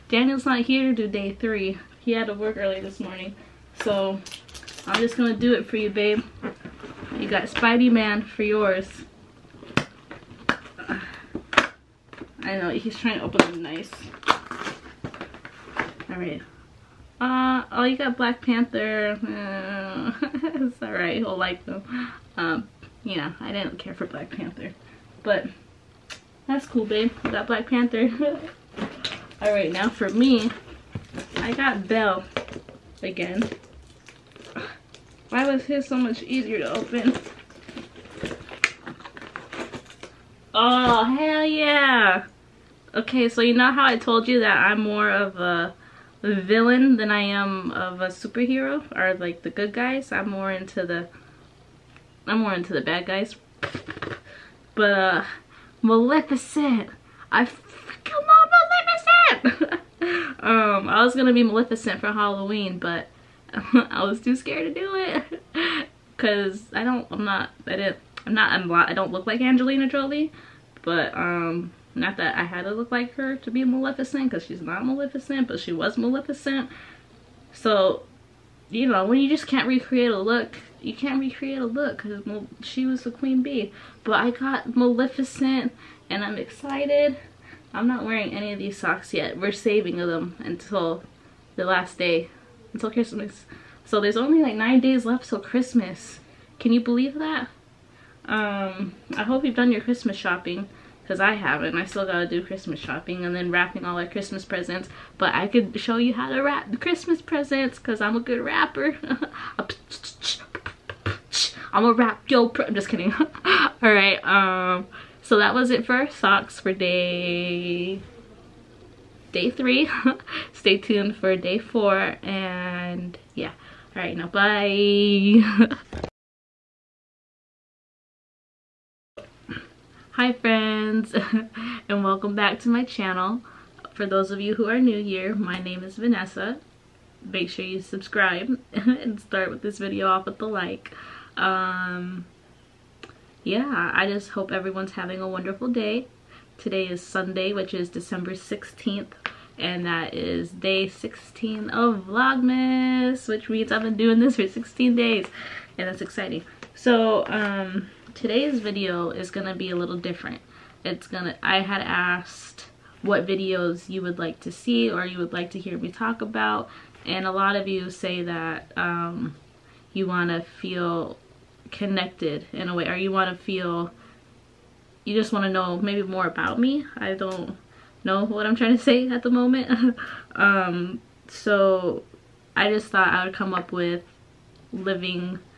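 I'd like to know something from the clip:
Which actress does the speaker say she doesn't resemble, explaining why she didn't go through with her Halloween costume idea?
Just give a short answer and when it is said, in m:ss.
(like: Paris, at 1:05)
Angelina Jolie, at 1:09.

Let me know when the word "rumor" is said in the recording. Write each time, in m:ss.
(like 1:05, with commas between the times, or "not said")
not said.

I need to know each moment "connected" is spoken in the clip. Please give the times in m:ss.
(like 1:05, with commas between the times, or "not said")
2:51.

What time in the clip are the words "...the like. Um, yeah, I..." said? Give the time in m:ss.
2:20.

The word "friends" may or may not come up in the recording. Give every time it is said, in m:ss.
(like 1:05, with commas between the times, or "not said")
2:10.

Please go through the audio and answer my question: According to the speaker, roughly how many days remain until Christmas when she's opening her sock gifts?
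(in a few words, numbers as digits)
9.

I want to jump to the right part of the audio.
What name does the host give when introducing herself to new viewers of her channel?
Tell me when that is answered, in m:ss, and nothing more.
2:15.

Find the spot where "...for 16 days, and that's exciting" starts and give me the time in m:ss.
2:34.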